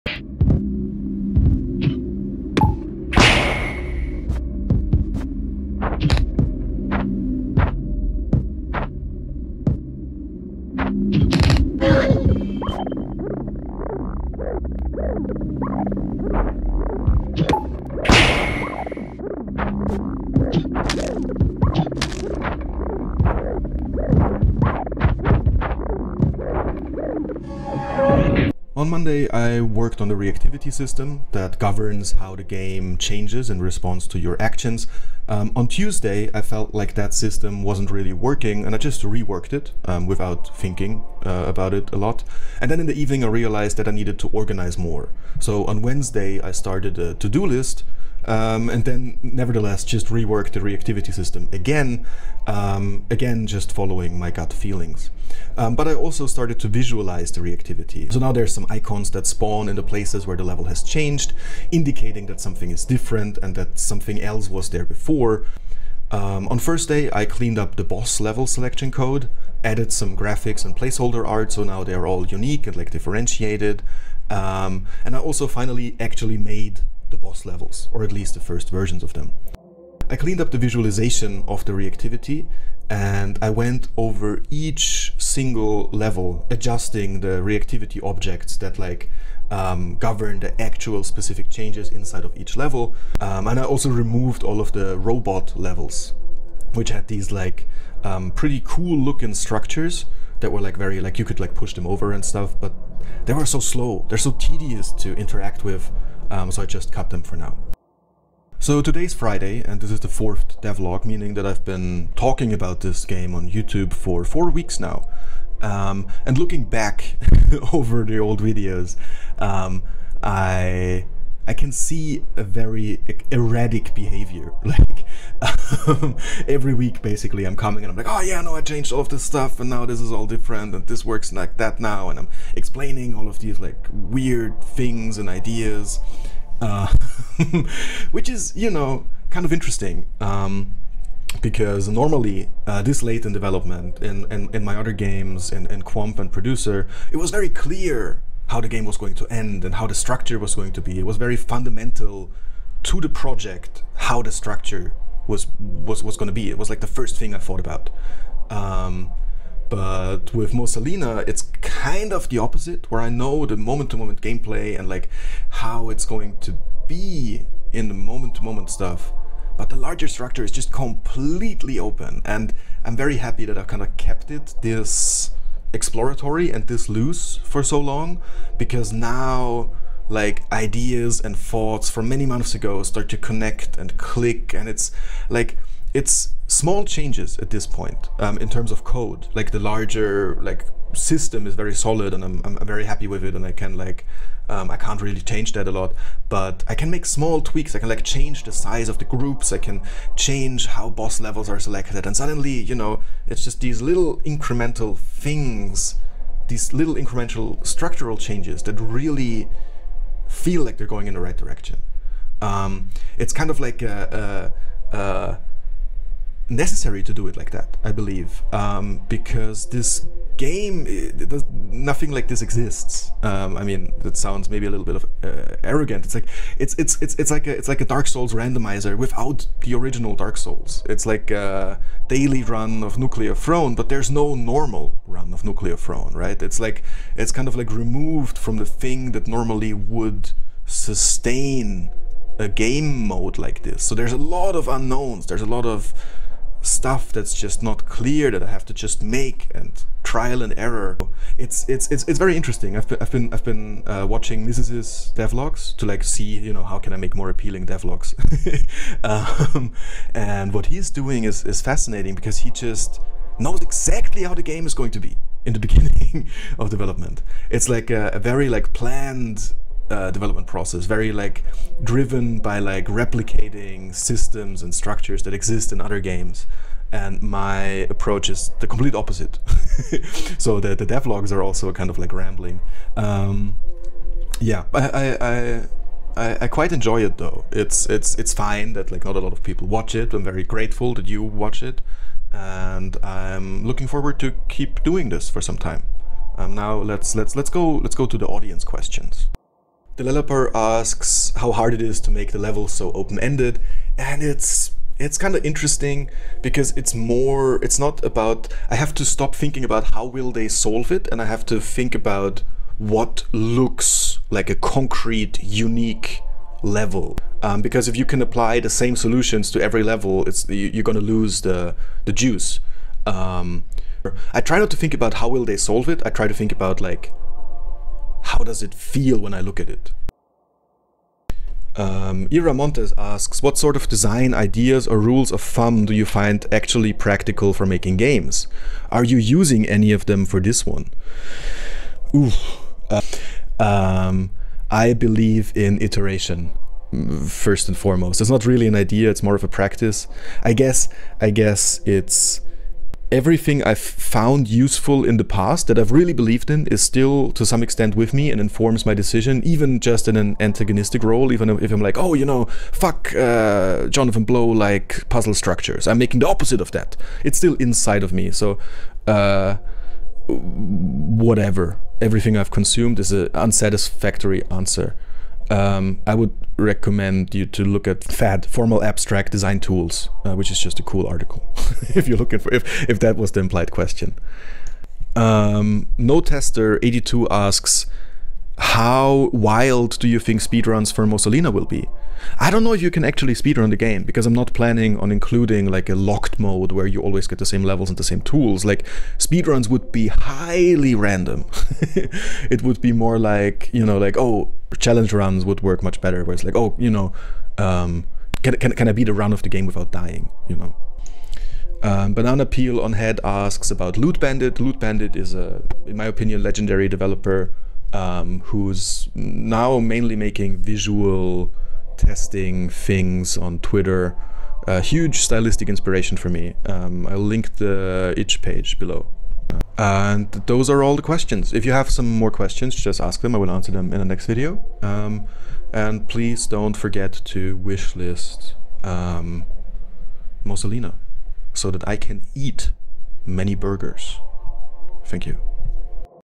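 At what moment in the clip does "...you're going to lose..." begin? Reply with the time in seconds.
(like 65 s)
320 s.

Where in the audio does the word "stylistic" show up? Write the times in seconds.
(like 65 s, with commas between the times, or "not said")
425 s.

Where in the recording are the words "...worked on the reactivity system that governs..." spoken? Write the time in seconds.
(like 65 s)
29 s.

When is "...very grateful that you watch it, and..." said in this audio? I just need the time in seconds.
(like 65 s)
290 s.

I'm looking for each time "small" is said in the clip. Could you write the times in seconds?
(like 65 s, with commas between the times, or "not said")
186 s, 197 s.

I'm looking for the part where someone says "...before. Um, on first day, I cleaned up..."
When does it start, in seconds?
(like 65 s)
64 s.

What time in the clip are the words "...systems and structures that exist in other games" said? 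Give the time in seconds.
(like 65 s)
273 s.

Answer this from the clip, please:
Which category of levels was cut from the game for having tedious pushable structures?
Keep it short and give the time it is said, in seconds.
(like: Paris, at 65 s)
robot levels, at 94 s.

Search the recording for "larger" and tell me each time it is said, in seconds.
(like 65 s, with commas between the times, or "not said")
169 s, 189 s.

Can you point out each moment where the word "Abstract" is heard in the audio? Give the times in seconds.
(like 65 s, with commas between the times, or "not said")
378 s.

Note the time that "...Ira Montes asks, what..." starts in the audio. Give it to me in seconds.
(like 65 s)
332 s.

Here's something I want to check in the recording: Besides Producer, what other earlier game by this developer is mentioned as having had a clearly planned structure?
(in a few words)
Quamp.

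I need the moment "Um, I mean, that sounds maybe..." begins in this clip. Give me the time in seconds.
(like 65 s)
223 s.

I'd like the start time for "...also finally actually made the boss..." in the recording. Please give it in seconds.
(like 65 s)
75 s.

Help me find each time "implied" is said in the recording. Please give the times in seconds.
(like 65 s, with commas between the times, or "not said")
383 s.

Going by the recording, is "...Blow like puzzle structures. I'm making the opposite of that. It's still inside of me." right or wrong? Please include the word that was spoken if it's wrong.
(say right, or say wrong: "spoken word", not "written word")
right.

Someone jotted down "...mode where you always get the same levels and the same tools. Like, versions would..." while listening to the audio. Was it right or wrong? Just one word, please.
wrong.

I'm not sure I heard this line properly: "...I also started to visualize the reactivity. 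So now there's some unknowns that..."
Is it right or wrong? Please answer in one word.
wrong.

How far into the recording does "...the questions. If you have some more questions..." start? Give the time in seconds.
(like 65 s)
430 s.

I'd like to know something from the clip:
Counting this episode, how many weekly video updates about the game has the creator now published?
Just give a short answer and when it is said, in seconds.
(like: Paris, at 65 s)
4, at 110 s.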